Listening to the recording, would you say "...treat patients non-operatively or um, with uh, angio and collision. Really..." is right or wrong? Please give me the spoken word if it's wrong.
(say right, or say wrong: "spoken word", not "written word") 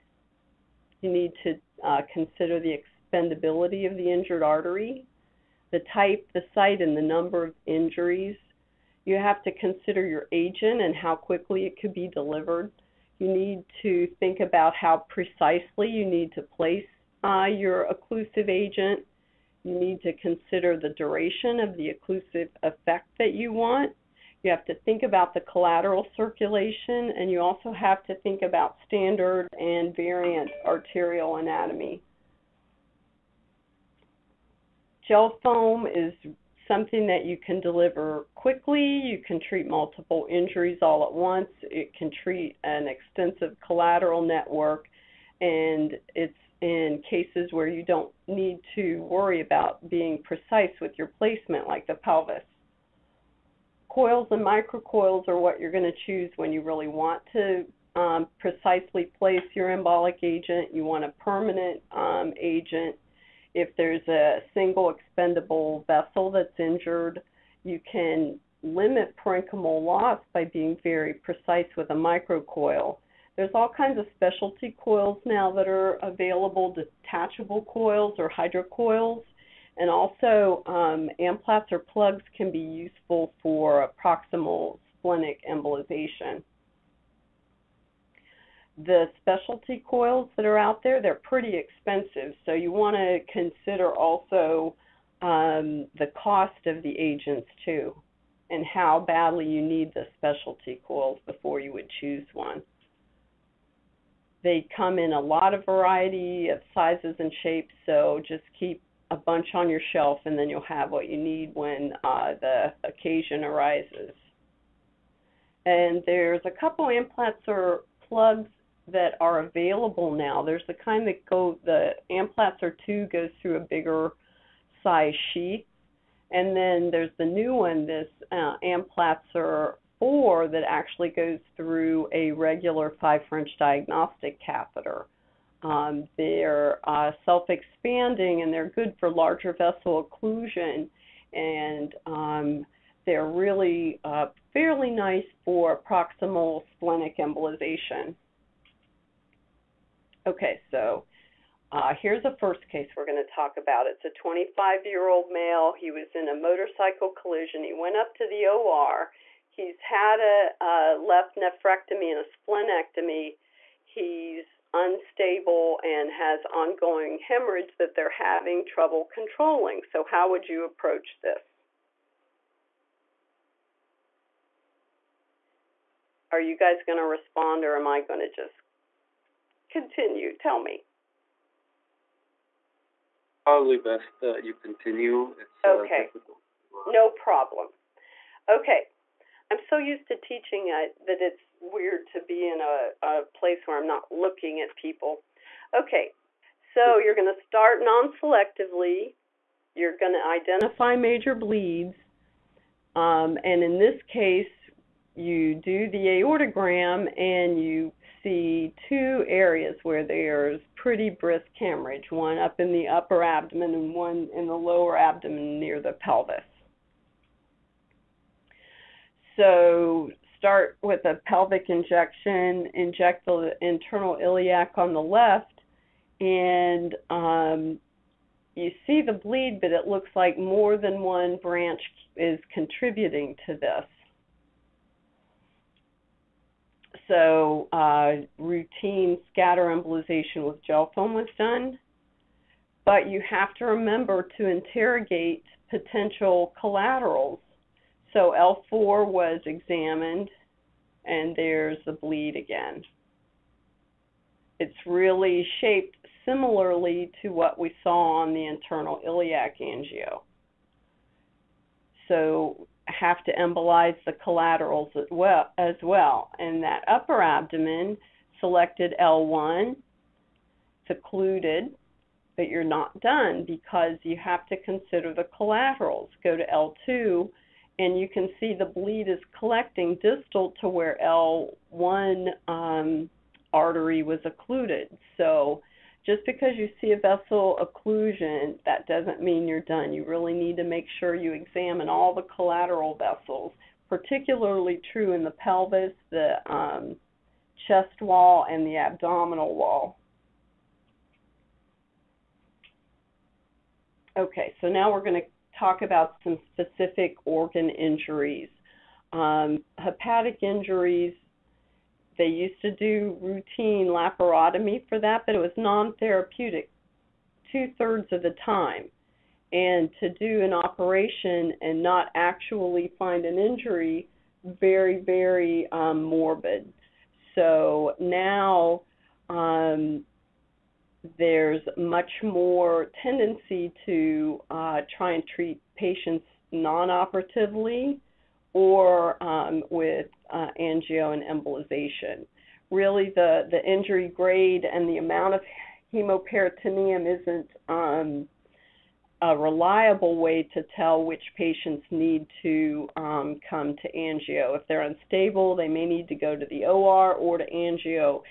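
wrong: "embolization", not "collision".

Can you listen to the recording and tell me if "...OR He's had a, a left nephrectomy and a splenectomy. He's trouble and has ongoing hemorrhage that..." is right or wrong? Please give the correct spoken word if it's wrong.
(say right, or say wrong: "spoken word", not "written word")
wrong: "unstable", not "trouble".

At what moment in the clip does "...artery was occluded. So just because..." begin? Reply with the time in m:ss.
4:43.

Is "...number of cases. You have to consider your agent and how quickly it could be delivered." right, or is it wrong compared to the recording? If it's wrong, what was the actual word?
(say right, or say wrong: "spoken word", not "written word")
wrong: "injuries", not "cases".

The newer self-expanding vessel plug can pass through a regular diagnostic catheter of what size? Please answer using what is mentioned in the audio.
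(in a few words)
5 French.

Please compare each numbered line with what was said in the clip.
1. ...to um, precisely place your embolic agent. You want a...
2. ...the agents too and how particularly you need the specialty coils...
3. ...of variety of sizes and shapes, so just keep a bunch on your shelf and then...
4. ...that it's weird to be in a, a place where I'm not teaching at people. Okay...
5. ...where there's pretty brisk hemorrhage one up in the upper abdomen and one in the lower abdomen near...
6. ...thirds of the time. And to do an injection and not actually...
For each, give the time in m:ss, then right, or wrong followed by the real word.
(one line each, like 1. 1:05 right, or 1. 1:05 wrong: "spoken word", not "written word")
1. 0:57 right
2. 1:36 wrong: "badly", not "particularly"
3. 1:45 right
4. 3:11 wrong: "looking", not "teaching"
5. 3:29 right
6. 5:17 wrong: "operation", not "injection".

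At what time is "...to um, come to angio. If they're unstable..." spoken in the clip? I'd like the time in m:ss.
5:52.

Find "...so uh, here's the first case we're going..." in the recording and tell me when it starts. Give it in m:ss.
2:30.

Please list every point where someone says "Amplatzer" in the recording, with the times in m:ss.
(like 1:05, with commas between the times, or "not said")
1:21, 1:56, 2:02, 2:08.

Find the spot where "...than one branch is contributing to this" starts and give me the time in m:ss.
3:50.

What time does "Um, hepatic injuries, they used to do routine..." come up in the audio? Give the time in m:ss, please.
5:09.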